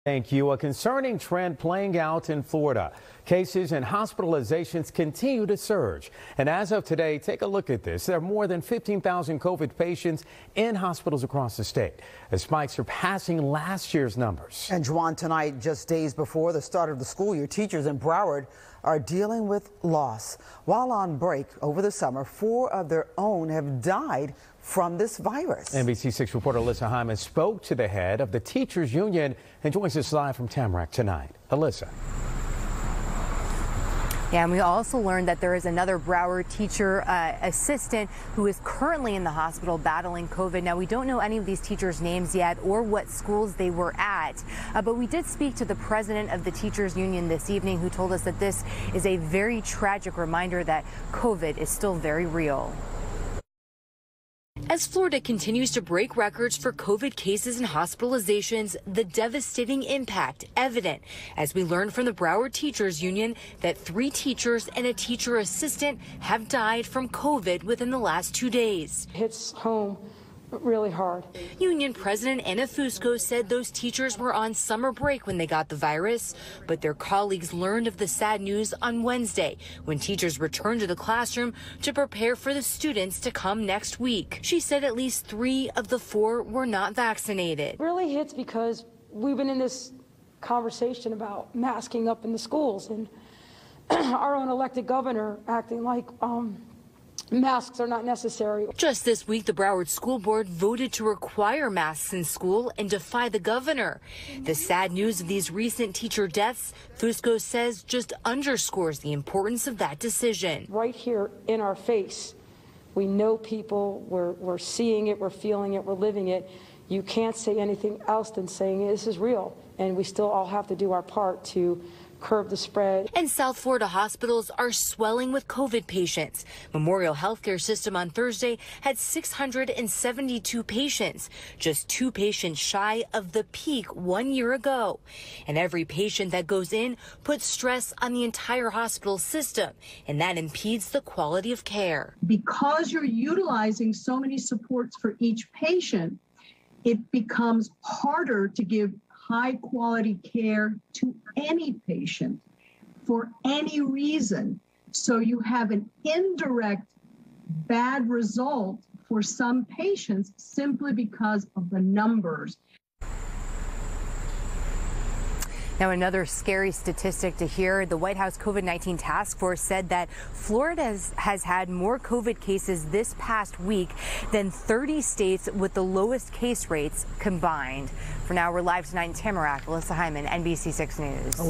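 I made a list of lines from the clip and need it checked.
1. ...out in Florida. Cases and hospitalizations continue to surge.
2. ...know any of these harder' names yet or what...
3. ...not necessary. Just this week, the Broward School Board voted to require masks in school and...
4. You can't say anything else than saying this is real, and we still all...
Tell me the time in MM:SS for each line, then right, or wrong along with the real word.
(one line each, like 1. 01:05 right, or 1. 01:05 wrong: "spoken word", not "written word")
1. 00:01 right
2. 00:41 wrong: "teachers", not "harder"
3. 01:37 right
4. 01:56 right.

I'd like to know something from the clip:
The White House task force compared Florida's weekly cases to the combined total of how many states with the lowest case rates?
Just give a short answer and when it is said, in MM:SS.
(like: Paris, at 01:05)
30, at 02:54.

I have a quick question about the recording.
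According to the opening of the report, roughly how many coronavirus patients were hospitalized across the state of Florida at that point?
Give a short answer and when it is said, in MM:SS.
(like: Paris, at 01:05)
15,000, at 00:08.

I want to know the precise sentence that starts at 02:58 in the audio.
For now, we're live tonight in Tamarac.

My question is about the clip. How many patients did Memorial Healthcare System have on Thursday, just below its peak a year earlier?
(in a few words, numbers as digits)
672.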